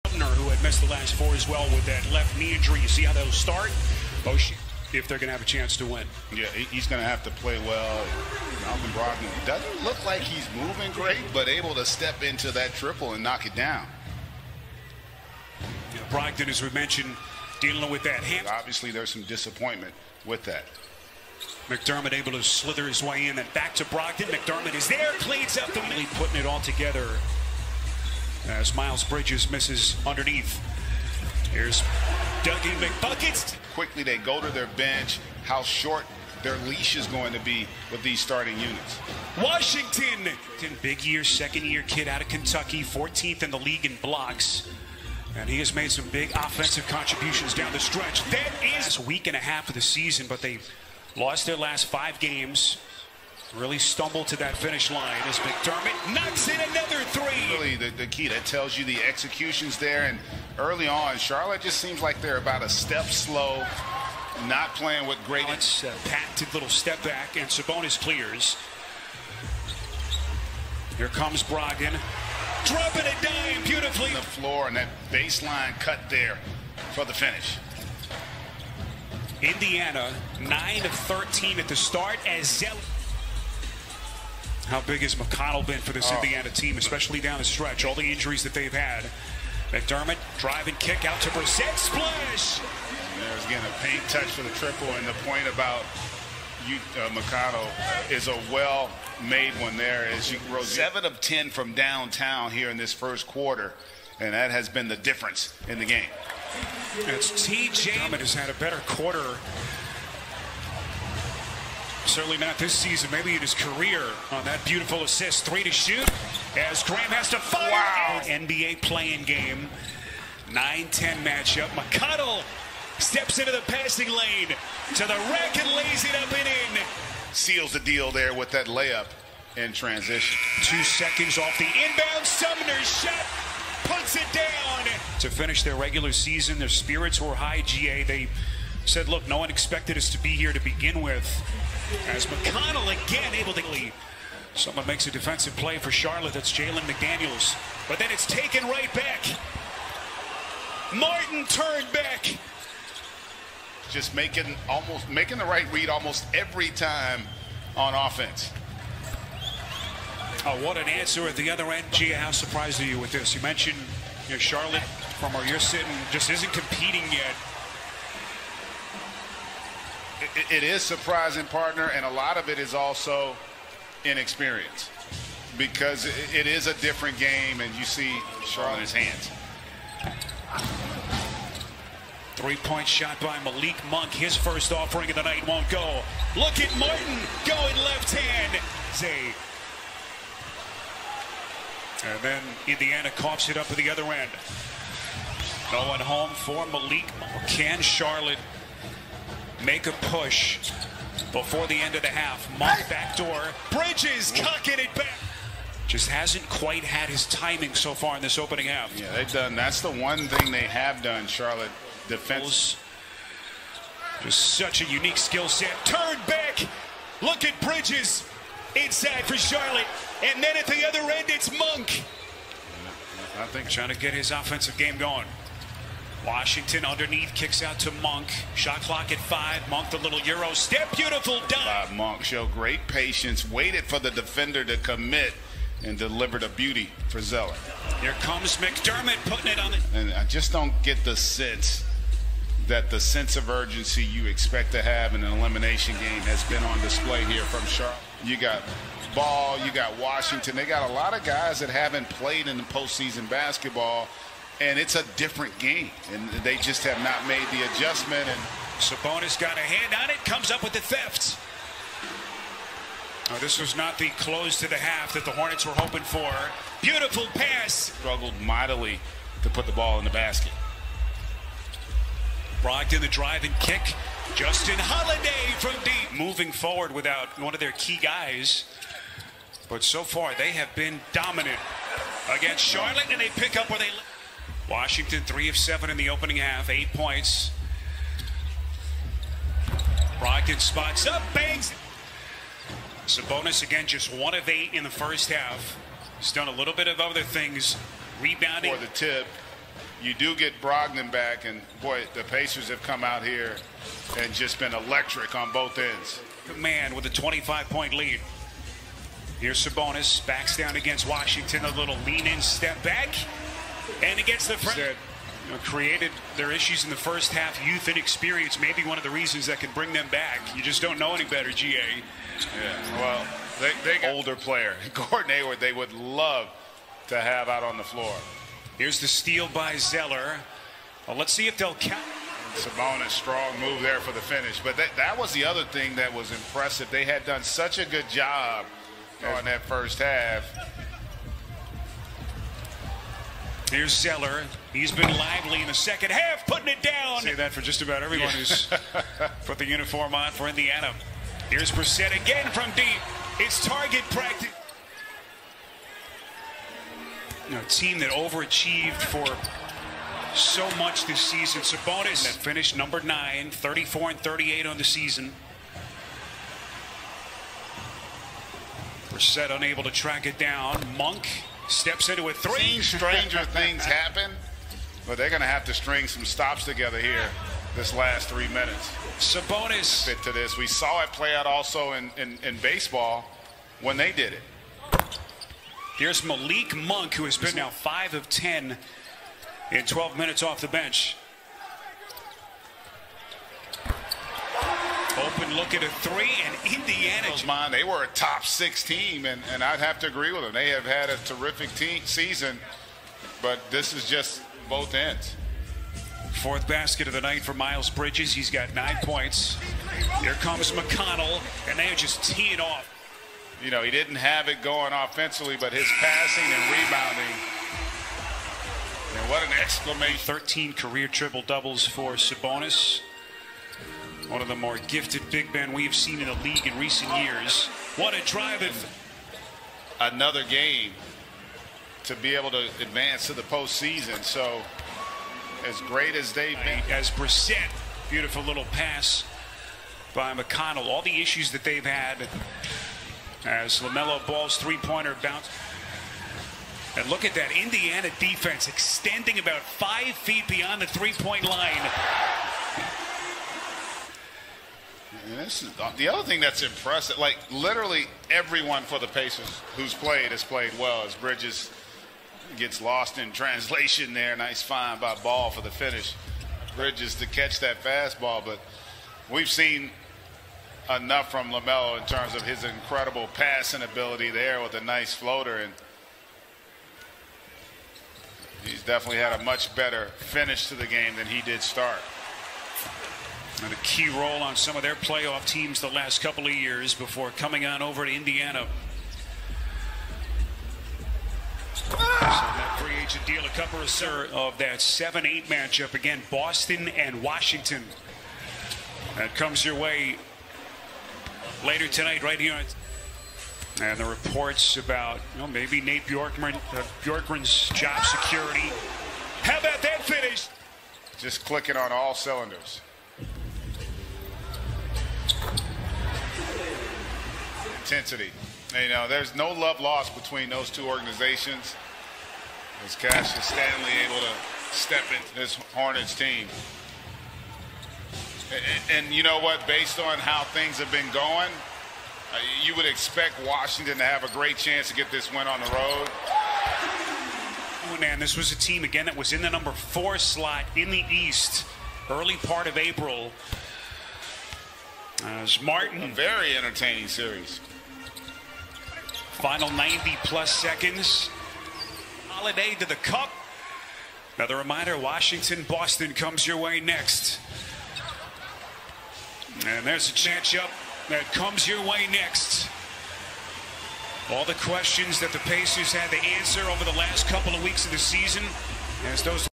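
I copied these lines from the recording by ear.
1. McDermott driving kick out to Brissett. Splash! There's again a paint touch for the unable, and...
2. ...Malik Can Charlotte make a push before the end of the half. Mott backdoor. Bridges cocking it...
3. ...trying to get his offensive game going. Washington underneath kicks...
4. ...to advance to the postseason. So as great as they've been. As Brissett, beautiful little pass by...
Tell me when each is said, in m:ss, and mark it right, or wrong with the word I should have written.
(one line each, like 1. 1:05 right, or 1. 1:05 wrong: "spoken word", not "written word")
1. 1:29 wrong: "triple", not "unable"
2. 3:16 right
3. 3:43 right
4. 7:12 right.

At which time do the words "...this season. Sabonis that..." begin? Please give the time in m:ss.
6:01.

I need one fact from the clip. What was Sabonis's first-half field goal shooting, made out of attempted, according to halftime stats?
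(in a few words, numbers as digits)
1 of 8.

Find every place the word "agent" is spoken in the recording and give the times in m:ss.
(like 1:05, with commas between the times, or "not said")
8:13.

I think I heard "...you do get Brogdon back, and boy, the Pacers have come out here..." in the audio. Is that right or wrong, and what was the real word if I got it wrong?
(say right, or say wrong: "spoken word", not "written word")
right.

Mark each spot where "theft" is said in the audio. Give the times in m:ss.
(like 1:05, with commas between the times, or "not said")
4:20.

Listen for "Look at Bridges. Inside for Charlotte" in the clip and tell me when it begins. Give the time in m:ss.
3:37.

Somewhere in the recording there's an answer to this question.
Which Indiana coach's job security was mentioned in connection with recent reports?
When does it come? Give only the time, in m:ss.
8:25.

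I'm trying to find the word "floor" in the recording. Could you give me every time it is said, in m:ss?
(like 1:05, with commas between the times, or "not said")
1:14, 5:27.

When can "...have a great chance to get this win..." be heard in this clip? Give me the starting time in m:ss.
8:54.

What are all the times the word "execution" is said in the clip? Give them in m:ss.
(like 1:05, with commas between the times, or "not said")
0:59.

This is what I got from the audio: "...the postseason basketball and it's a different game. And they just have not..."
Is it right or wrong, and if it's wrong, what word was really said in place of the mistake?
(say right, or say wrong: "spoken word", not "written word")
right.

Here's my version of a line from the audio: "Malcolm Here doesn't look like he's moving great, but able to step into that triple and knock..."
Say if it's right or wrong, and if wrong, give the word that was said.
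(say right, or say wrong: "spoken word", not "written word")
wrong: "Brogdon", not "Here".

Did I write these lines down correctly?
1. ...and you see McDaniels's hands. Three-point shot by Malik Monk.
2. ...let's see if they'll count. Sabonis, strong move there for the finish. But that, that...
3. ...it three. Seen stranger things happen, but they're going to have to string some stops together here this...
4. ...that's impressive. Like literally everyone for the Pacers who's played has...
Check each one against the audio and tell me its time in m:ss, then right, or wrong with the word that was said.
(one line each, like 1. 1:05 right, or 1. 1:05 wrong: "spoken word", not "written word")
1. 2:57 wrong: "Charlotte", not "McDaniels"
2. 5:31 right
3. 6:12 right
4. 7:36 right.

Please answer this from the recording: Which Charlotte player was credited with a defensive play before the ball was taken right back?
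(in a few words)
Jalen McDaniels.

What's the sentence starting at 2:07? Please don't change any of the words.
Seals the deal there with that layup in transition.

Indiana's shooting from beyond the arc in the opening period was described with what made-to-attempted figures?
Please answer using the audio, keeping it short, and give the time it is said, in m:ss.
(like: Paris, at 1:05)
7 of 10, at 1:40.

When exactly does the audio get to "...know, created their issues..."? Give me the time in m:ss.
5:15.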